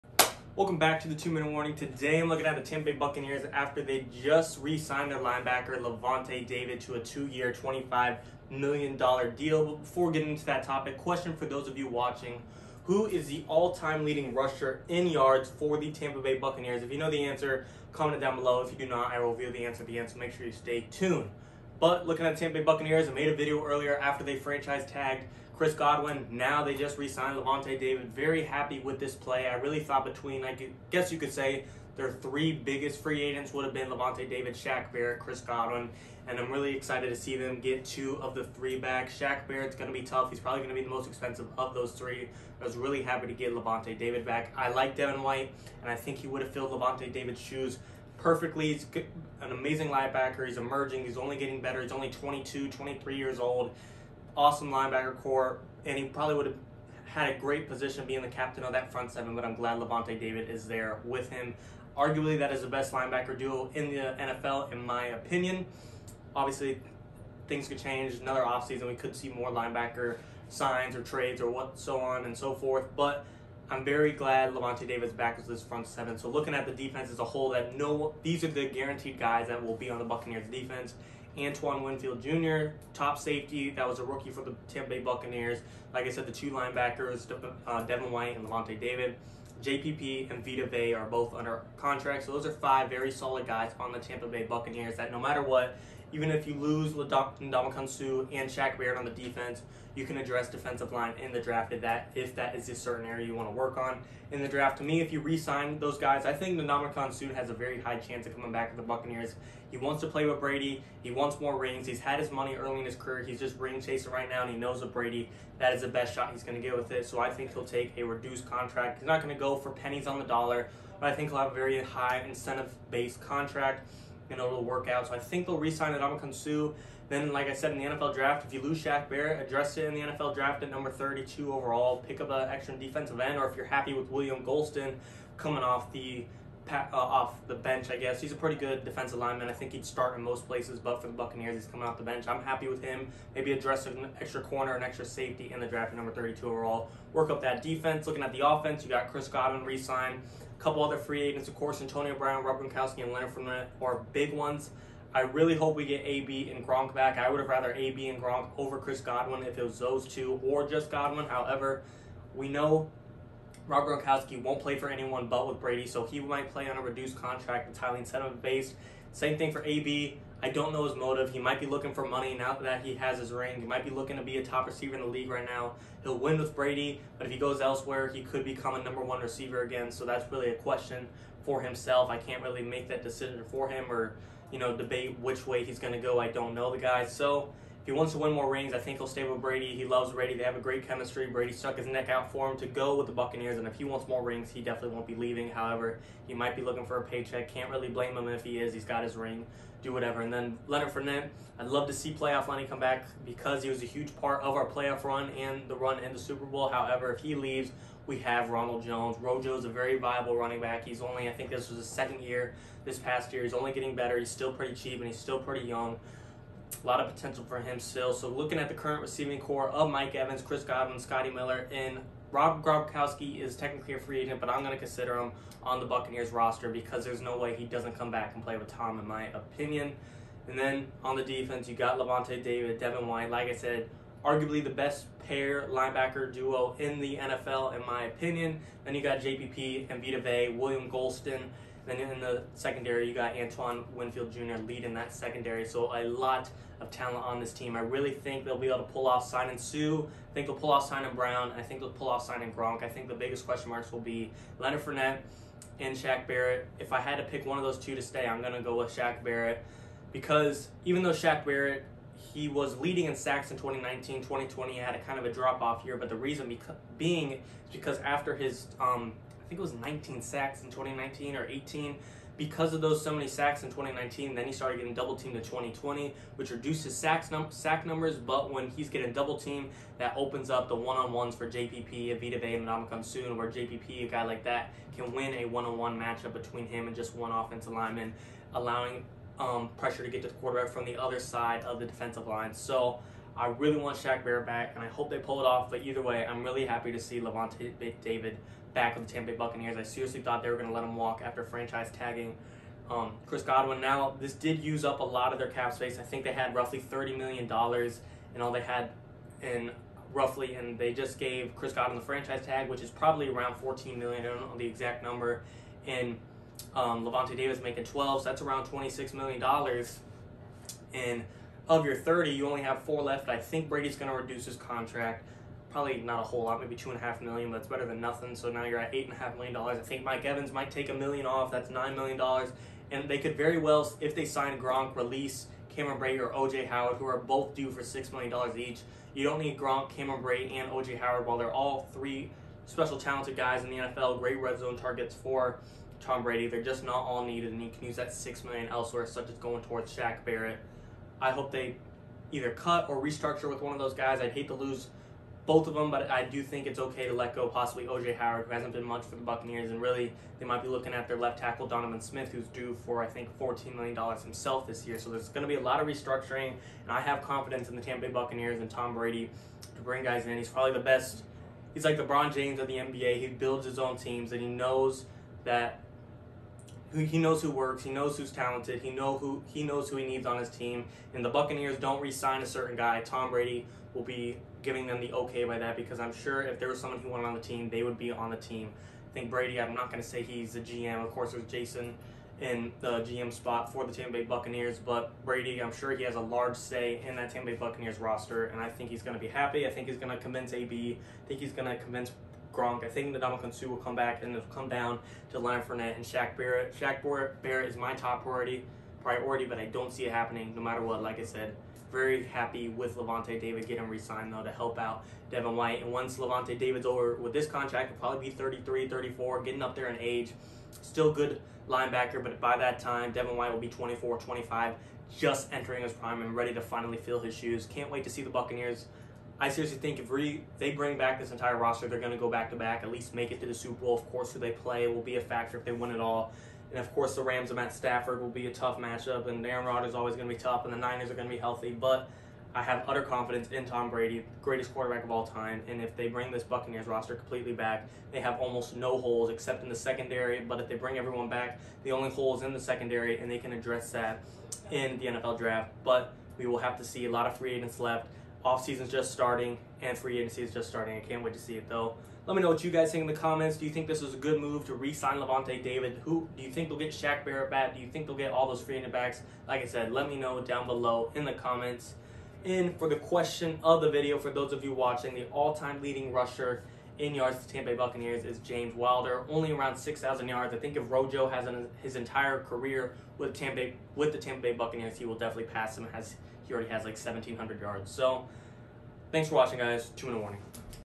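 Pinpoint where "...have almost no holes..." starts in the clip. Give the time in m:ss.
7:28.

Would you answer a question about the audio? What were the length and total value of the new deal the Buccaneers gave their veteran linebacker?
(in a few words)
2 years, $25 million.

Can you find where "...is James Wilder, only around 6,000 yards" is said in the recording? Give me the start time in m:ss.
7:58.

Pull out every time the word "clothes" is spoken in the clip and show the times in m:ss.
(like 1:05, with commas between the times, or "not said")
not said.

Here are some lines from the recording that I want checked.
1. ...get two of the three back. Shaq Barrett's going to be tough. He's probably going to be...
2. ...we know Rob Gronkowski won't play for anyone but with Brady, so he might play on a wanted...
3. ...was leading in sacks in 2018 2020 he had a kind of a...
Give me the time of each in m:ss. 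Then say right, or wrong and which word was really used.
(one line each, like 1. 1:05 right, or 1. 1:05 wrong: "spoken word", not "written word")
1. 0:37 right
2. 2:42 wrong: "reduced", not "wanted"
3. 4:22 wrong: "2019", not "2018".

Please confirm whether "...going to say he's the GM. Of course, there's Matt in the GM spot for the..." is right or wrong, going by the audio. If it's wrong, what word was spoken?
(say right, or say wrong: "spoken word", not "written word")
wrong: "Jason", not "Matt".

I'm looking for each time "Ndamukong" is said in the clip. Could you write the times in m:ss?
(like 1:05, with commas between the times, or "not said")
1:37, 1:46, 6:43.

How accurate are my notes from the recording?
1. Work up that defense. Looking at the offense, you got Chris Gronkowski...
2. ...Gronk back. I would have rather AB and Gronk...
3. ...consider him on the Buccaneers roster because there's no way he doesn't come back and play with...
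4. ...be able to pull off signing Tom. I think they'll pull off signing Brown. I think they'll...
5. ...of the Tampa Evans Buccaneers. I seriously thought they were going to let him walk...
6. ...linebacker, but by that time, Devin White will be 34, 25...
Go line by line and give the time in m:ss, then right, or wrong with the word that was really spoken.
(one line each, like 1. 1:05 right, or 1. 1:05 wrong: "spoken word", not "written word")
1. 2:27 wrong: "Godwin", not "Gronkowski"
2. 2:36 right
3. 3:44 right
4. 4:08 wrong: "Suh", not "Tom"
5. 4:58 wrong: "Bay", not "Evans"
6. 7:01 wrong: "24", not "34".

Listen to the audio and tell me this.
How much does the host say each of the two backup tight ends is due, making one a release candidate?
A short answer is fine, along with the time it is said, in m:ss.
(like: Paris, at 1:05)
$6 million, at 5:37.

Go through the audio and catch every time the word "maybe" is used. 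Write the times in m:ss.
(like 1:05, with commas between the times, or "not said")
2:23, 5:26.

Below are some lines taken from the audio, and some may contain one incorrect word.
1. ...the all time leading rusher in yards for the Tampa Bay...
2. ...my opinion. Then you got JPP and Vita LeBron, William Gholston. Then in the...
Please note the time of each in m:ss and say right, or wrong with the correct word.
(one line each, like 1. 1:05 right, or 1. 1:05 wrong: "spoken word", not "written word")
1. 0:13 right
2. 3:57 wrong: "Vea", not "LeBron".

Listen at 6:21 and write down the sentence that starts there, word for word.
And the Buccaneers don't re-sign a certain guy.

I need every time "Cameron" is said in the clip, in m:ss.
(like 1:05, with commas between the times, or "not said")
5:35, 5:39.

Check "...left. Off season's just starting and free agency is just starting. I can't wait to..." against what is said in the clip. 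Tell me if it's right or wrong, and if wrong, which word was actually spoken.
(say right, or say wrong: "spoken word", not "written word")
right.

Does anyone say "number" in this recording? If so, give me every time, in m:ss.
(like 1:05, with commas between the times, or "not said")
2:10, 2:25, 2:58, 4:37, 5:15.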